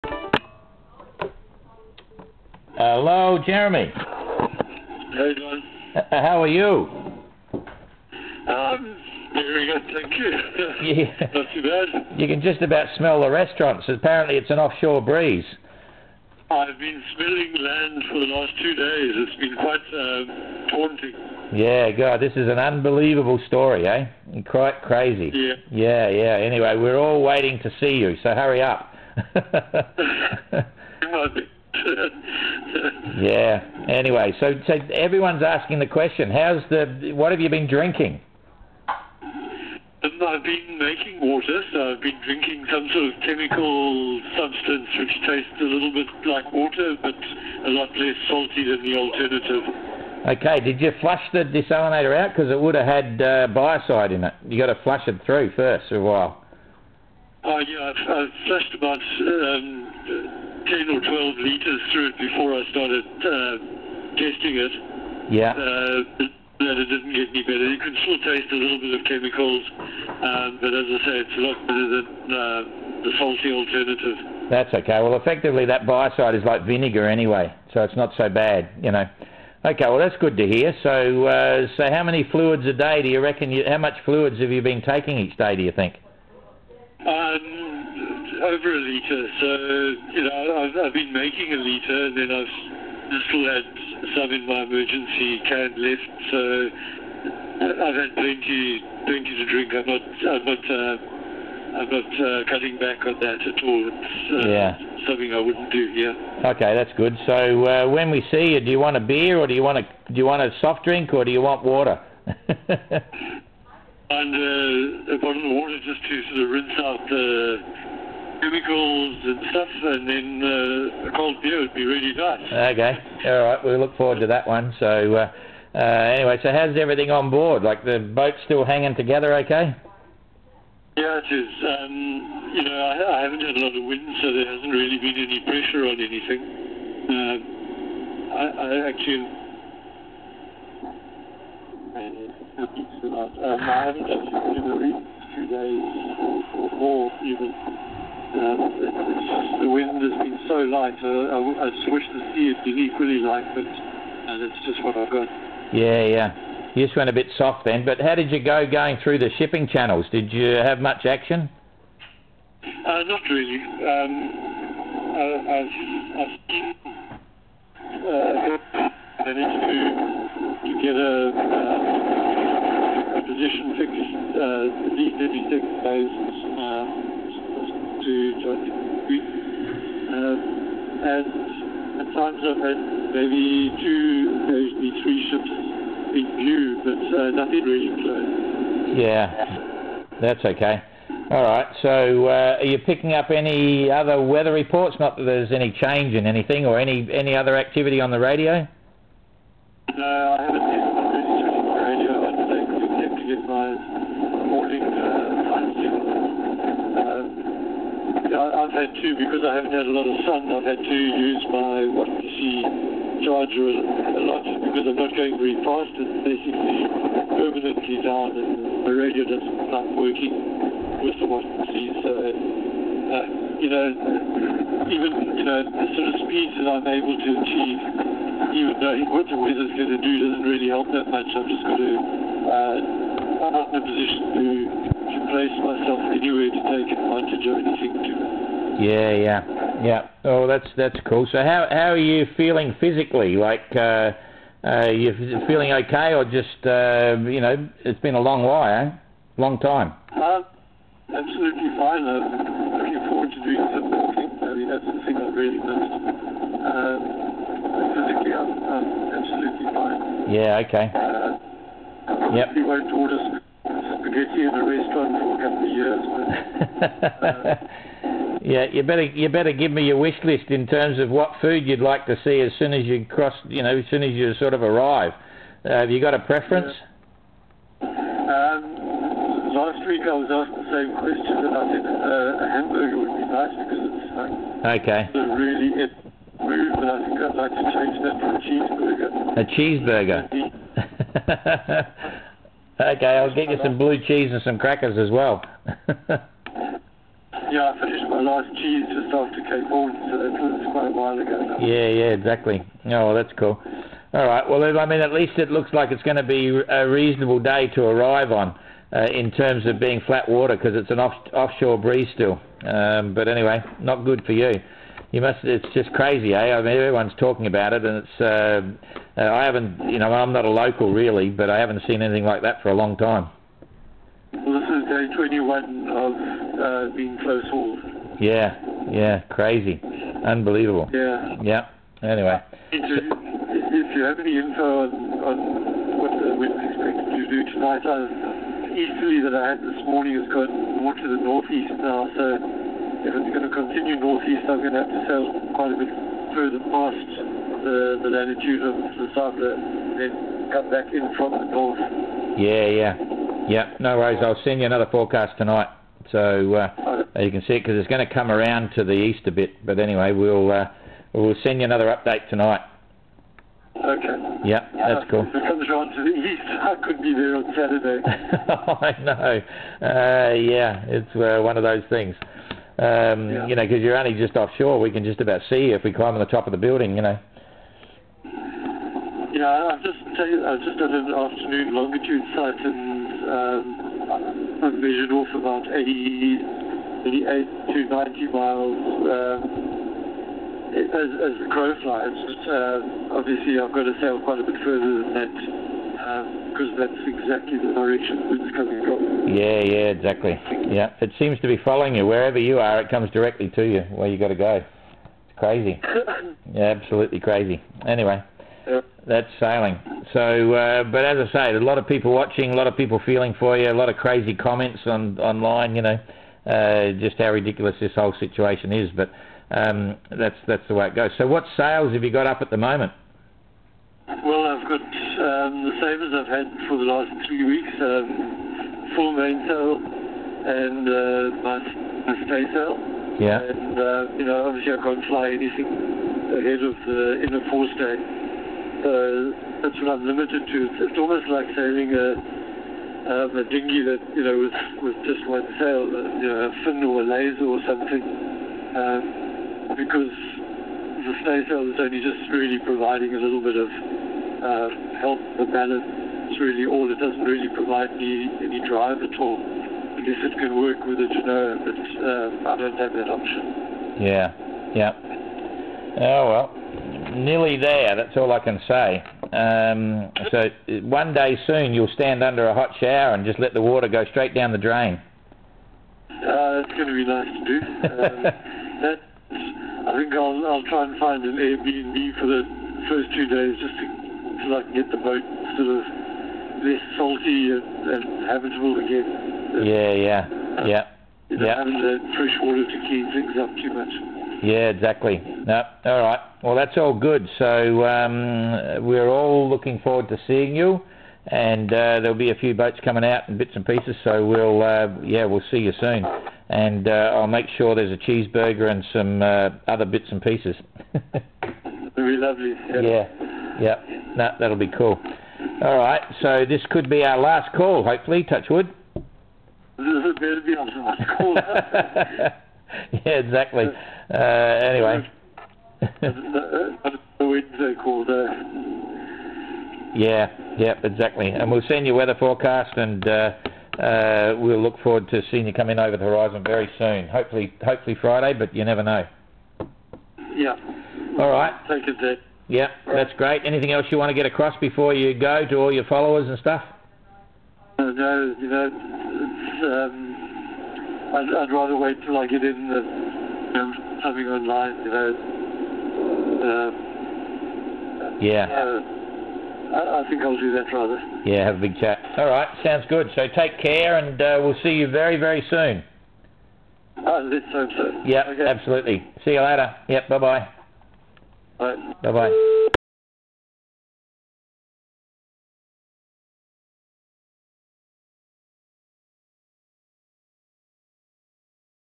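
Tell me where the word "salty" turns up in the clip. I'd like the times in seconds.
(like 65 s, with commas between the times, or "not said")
48 s, 73 s, 486 s.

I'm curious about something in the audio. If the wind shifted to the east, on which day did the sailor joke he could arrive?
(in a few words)
Saturday.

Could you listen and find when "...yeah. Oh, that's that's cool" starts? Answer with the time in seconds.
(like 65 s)
239 s.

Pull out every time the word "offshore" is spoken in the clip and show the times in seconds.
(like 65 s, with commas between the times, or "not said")
14 s, 311 s, 374 s.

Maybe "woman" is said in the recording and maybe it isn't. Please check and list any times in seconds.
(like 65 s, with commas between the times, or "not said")
not said.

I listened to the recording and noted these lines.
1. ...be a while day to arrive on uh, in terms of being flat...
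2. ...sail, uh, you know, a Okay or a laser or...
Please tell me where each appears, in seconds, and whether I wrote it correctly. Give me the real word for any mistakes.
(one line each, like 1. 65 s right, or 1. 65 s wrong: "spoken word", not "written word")
1. 306 s wrong: "reasonable", not "while"
2. 445 s wrong: "Finn", not "Okay".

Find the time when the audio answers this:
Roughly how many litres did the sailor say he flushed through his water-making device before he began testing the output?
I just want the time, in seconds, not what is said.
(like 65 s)
60 s.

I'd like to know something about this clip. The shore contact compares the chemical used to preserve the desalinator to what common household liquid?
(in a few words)
vinegar.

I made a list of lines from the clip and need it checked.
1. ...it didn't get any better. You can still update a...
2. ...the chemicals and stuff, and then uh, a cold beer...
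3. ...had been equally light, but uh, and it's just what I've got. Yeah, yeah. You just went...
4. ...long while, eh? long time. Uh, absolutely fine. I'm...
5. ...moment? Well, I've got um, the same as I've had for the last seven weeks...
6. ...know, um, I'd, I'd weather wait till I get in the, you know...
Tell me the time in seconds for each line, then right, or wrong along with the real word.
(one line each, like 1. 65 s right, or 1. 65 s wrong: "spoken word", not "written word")
1. 66 s wrong: "taste", not "update"
2. 117 s right
3. 152 s right
4. 248 s right
5. 422 s wrong: "three", not "seven"
6. 548 s wrong: "rather", not "weather".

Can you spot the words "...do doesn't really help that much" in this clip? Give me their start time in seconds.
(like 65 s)
230 s.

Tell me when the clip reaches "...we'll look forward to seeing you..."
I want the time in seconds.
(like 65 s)
534 s.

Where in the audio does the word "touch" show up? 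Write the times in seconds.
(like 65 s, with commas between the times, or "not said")
518 s.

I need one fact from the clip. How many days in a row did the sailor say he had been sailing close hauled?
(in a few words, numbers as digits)
21.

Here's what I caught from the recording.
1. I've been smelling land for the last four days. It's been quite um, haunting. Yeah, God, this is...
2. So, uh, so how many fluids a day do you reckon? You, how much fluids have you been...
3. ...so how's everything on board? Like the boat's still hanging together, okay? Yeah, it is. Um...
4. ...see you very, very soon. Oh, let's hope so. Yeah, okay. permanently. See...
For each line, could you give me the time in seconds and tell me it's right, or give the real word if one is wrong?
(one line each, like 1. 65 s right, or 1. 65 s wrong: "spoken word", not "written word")
1. 16 s wrong: "two", not "four"
2. 80 s right
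3. 126 s right
4. 564 s wrong: "absolutely", not "permanently".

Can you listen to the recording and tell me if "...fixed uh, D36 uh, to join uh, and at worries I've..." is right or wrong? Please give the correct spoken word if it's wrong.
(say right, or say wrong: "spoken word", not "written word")
wrong: "times", not "worries".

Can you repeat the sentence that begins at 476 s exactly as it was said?
Uh, that's going to be nice to do.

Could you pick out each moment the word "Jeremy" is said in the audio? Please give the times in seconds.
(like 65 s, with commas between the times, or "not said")
3 s.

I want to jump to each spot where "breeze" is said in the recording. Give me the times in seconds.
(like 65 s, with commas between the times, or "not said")
14 s, 311 s.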